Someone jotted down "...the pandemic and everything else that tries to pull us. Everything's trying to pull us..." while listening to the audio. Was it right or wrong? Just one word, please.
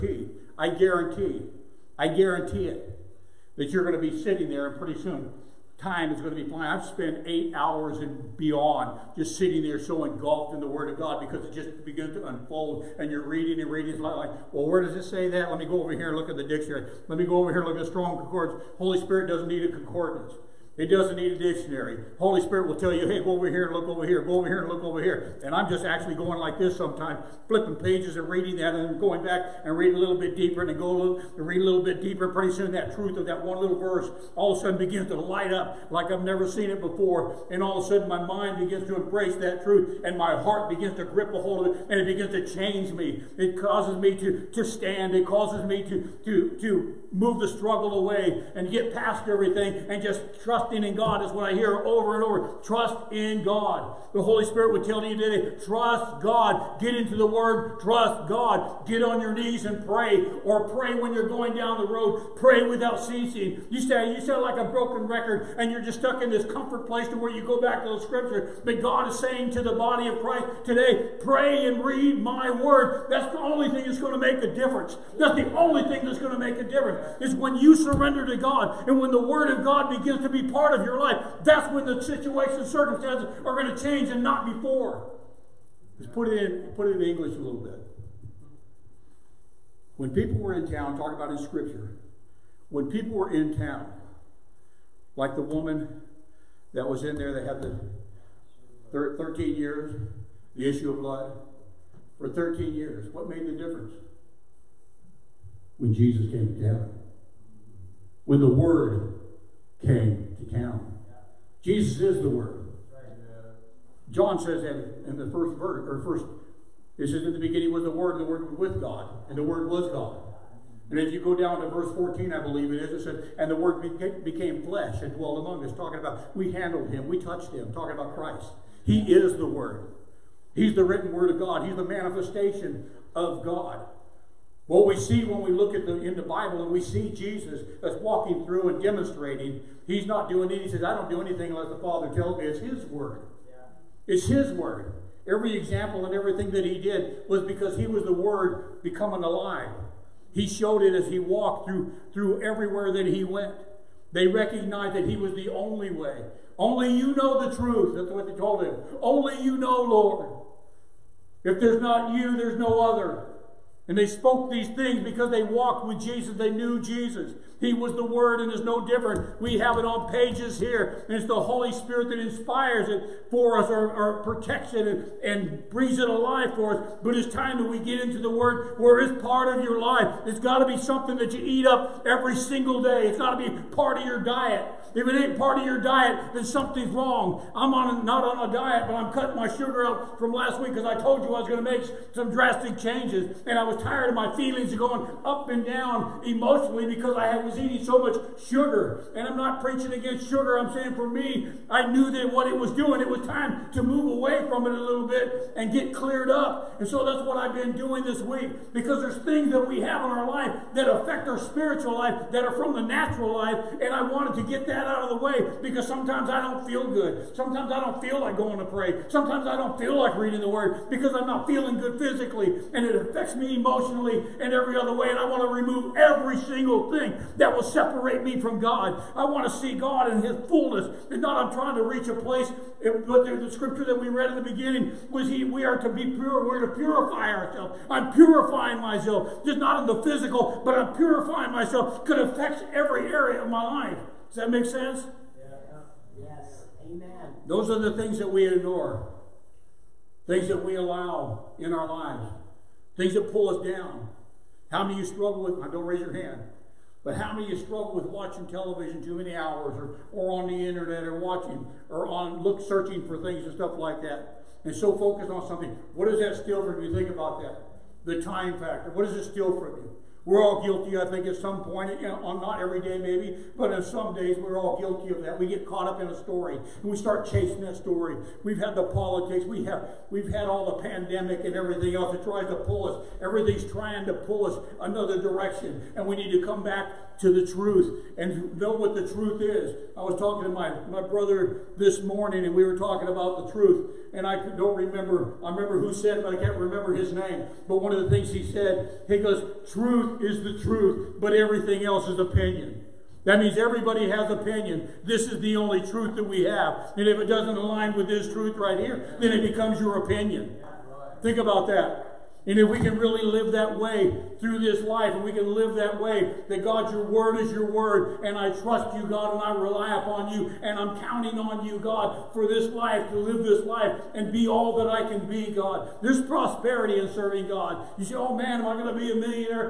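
right.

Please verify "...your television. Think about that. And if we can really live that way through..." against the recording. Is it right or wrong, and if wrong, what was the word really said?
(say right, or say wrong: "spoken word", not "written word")
wrong: "opinion", not "television".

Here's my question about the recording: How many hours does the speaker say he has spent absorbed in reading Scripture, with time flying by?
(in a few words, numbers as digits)
8.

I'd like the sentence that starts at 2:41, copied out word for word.
If there's not you, there's no other.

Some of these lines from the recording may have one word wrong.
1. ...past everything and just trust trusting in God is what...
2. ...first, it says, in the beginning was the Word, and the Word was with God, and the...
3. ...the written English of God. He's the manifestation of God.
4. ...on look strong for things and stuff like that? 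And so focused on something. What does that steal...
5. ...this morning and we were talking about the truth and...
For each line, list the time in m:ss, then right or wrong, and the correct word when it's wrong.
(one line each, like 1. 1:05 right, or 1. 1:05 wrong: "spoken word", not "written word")
1. 0:48 right
2. 1:56 right
3. 2:10 wrong: "Word", not "English"
4. 4:22 wrong: "searching", not "strong"
5. 4:51 right.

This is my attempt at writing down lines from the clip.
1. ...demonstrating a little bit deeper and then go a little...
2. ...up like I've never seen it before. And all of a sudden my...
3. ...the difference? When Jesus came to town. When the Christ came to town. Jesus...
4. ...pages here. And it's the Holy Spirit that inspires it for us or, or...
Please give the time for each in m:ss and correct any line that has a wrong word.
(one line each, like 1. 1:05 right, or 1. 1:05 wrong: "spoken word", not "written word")
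1. 0:29 wrong: "reading", not "demonstrating"
2. 0:35 right
3. 1:43 wrong: "Word", not "Christ"
4. 2:50 right.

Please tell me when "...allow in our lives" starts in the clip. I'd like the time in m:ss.
4:10.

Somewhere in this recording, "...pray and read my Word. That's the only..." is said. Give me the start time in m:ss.
1:11.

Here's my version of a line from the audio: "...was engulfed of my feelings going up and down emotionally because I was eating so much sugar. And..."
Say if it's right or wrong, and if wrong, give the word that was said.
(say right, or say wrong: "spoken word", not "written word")
wrong: "tired", not "engulfed".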